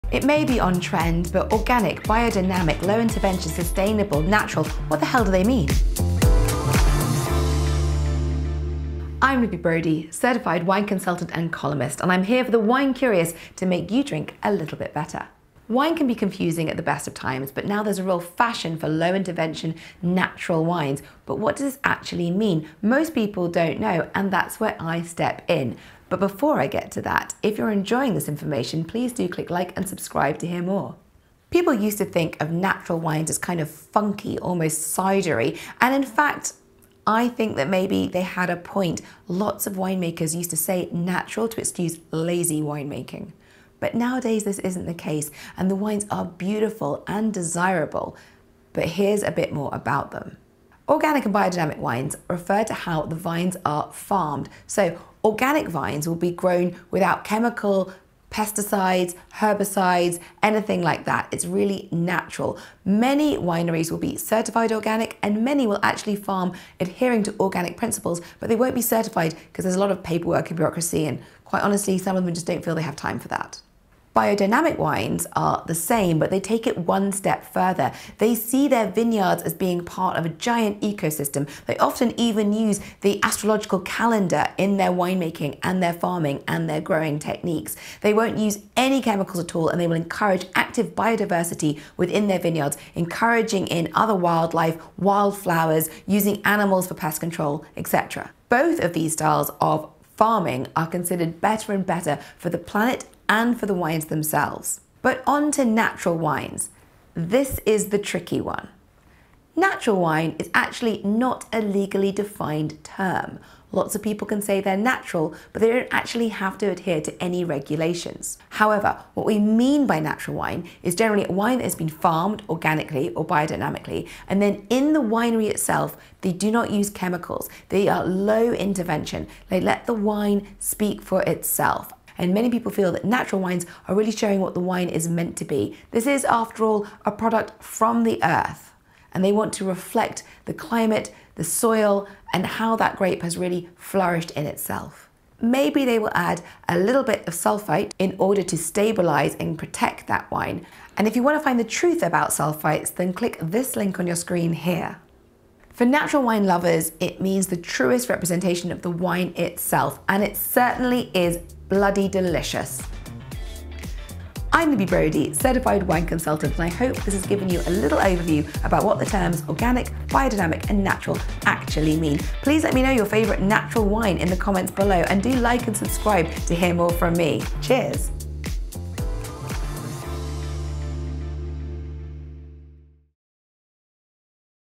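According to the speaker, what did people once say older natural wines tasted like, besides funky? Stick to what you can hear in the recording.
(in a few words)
cidery.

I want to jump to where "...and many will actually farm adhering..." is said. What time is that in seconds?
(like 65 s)
65 s.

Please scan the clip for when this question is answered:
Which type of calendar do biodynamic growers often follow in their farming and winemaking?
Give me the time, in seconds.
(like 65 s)
83 s.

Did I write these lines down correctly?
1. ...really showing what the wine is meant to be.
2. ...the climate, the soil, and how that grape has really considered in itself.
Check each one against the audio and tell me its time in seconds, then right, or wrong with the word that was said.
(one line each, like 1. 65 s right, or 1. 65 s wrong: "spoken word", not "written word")
1. 133 s right
2. 140 s wrong: "flourished", not "considered".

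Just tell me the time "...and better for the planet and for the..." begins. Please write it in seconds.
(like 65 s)
101 s.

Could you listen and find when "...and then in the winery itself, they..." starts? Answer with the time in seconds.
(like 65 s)
124 s.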